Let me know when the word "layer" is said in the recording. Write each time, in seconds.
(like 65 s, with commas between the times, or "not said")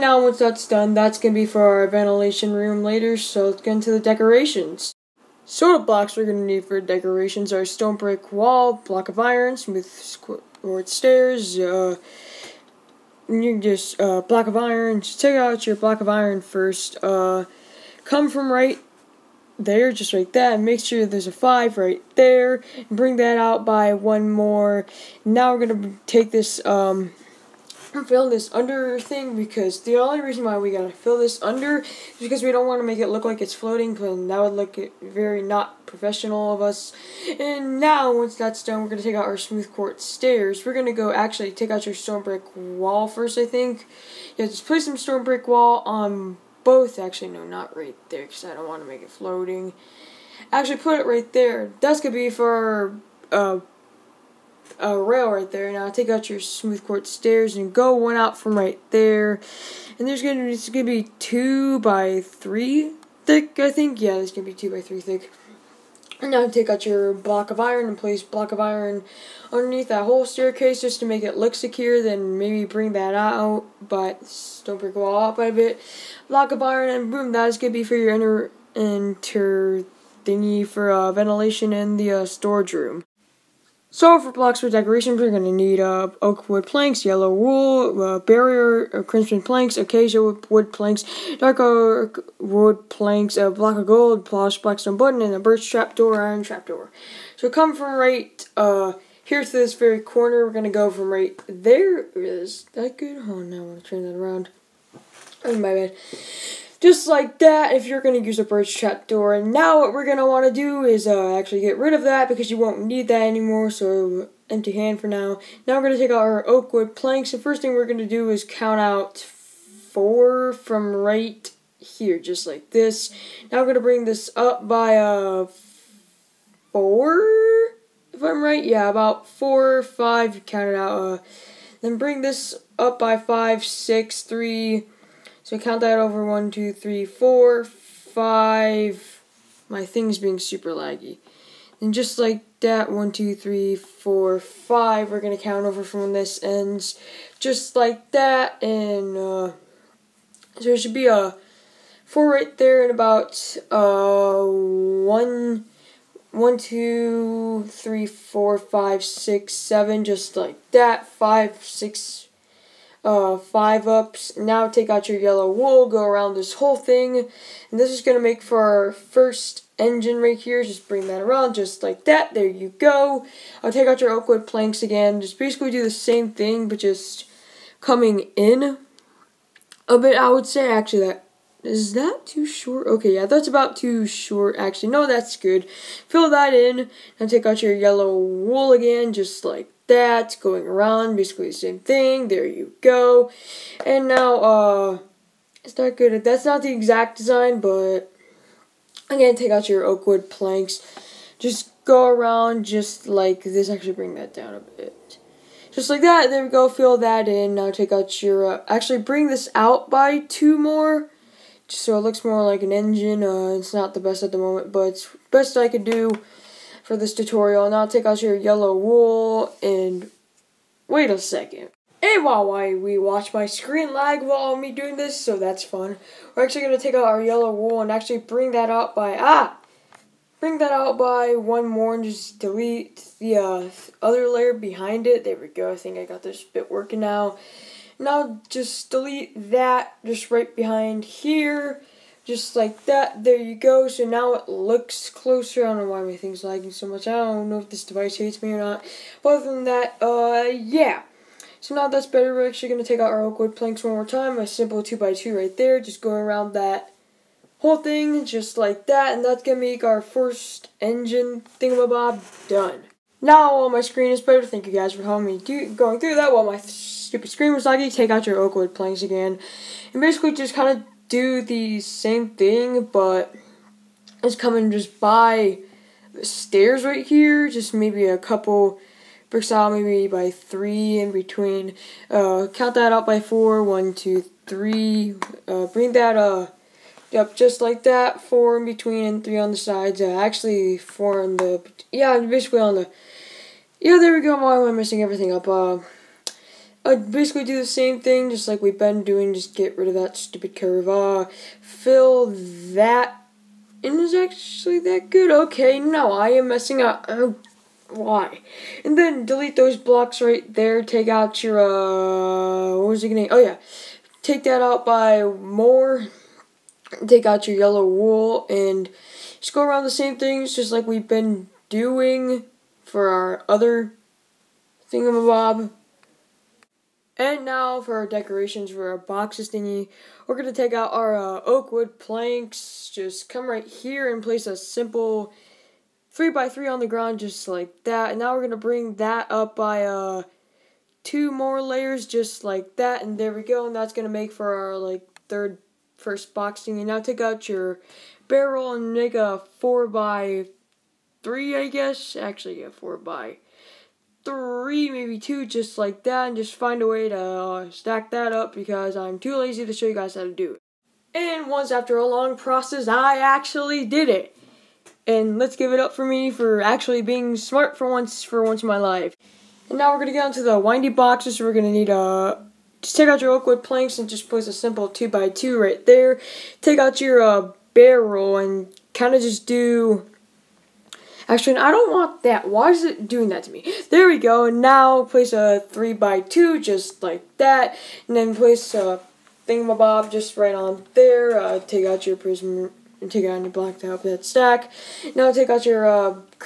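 234 s, 341 s.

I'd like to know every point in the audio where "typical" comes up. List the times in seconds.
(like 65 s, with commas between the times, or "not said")
not said.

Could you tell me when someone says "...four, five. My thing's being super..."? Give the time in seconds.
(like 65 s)
137 s.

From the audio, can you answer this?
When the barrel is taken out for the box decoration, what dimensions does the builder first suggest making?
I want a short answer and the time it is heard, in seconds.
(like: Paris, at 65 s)
4 by 3, at 349 s.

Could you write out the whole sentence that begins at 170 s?
Just bring that around just like that.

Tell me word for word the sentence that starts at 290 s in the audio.
Uh, actually, four on the, yeah, basically on the, yeah, there we go.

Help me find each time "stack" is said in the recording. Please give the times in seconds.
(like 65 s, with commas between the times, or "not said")
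357 s, 394 s.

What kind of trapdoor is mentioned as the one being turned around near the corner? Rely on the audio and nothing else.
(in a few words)
Birch trapdoor.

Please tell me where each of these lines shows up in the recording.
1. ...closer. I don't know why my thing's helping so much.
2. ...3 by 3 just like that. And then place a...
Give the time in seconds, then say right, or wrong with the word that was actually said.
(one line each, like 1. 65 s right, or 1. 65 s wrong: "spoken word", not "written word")
1. 245 s wrong: "lagging", not "helping"
2. 385 s wrong: "2", not "3".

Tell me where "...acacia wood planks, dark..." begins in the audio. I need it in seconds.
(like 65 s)
89 s.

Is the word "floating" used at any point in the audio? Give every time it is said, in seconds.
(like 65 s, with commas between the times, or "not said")
33 s, 49 s.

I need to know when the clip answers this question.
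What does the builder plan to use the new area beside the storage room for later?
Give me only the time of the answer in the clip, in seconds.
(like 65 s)
1 s.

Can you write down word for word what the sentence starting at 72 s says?
Then maybe bring that out, but don't break the wall out by a bit.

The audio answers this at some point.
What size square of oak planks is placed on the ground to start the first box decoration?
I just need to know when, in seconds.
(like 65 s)
336 s.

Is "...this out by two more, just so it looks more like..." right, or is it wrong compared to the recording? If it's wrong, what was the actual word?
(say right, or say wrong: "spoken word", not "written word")
right.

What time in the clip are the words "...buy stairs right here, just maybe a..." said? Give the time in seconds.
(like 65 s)
274 s.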